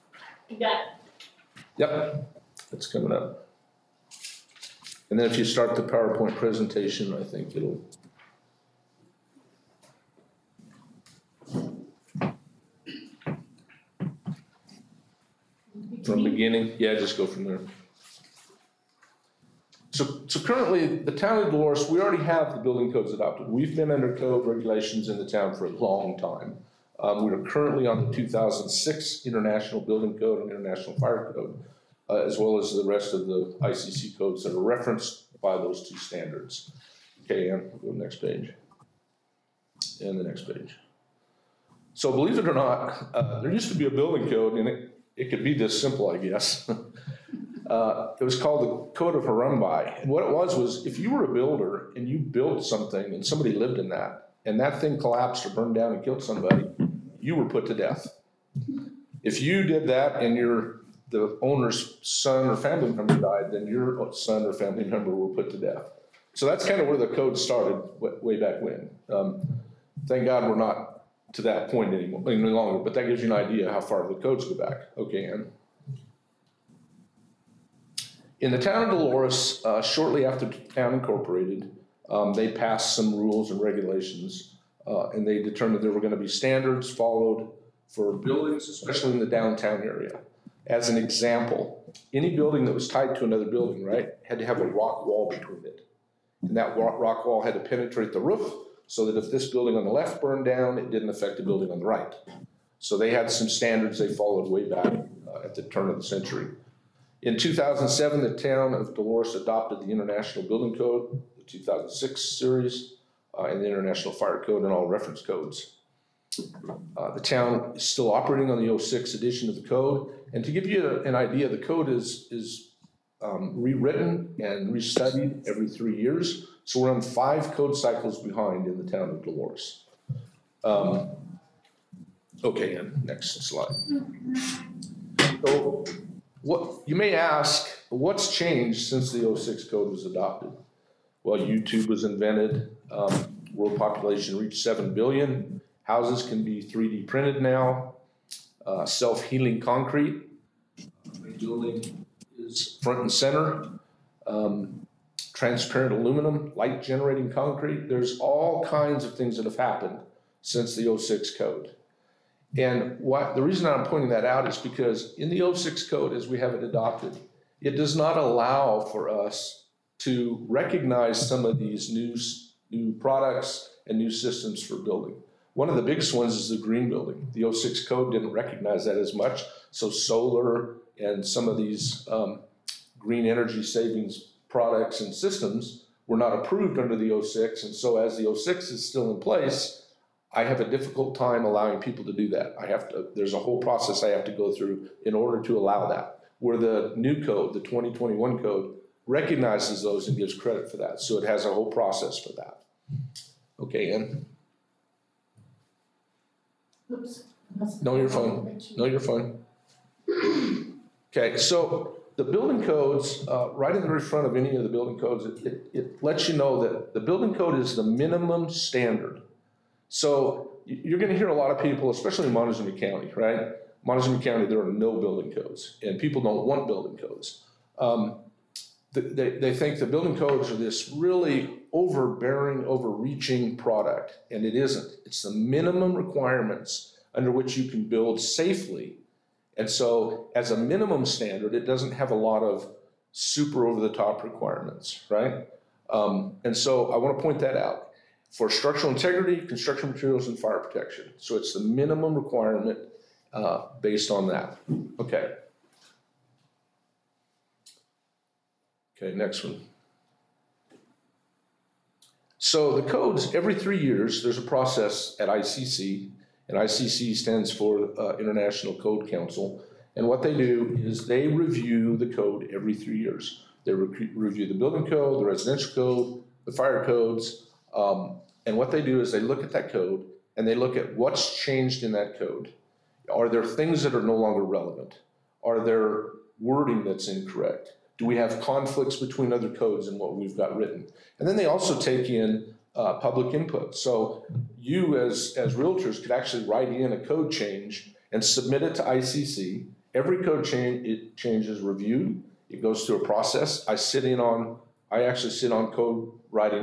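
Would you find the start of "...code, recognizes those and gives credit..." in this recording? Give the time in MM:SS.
03:18.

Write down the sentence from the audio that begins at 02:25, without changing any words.
Houses can be 3D printed now.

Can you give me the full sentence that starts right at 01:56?
Uh, the town is still operating on the 06 edition of the code.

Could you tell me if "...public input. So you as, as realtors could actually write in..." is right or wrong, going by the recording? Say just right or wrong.
right.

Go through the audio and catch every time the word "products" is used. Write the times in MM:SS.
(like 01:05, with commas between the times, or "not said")
02:52, 03:04, 03:53.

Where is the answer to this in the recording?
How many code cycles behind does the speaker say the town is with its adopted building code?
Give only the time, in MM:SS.
02:07.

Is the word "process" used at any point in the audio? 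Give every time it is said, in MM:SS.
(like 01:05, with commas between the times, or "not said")
03:13, 03:21, 04:24, 05:03.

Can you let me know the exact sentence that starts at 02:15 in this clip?
So what, you may ask, what's changed since the 06 code was adopted?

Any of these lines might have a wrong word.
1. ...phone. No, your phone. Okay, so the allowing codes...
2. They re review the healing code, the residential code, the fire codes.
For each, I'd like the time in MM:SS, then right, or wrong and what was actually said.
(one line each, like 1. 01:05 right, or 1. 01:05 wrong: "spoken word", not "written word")
1. 03:28 wrong: "building", not "allowing"
2. 04:33 wrong: "building", not "healing".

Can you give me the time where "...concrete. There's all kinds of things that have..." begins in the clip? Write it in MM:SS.
02:37.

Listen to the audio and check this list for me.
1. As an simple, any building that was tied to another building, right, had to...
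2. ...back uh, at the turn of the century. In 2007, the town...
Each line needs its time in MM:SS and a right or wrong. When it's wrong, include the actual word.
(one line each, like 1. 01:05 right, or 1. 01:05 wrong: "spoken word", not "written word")
1. 01:30 wrong: "example", not "simple"
2. 01:44 right.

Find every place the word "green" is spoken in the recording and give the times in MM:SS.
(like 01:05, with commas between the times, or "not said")
02:56, 03:02.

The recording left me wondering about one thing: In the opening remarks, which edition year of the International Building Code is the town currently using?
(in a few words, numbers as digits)
2006.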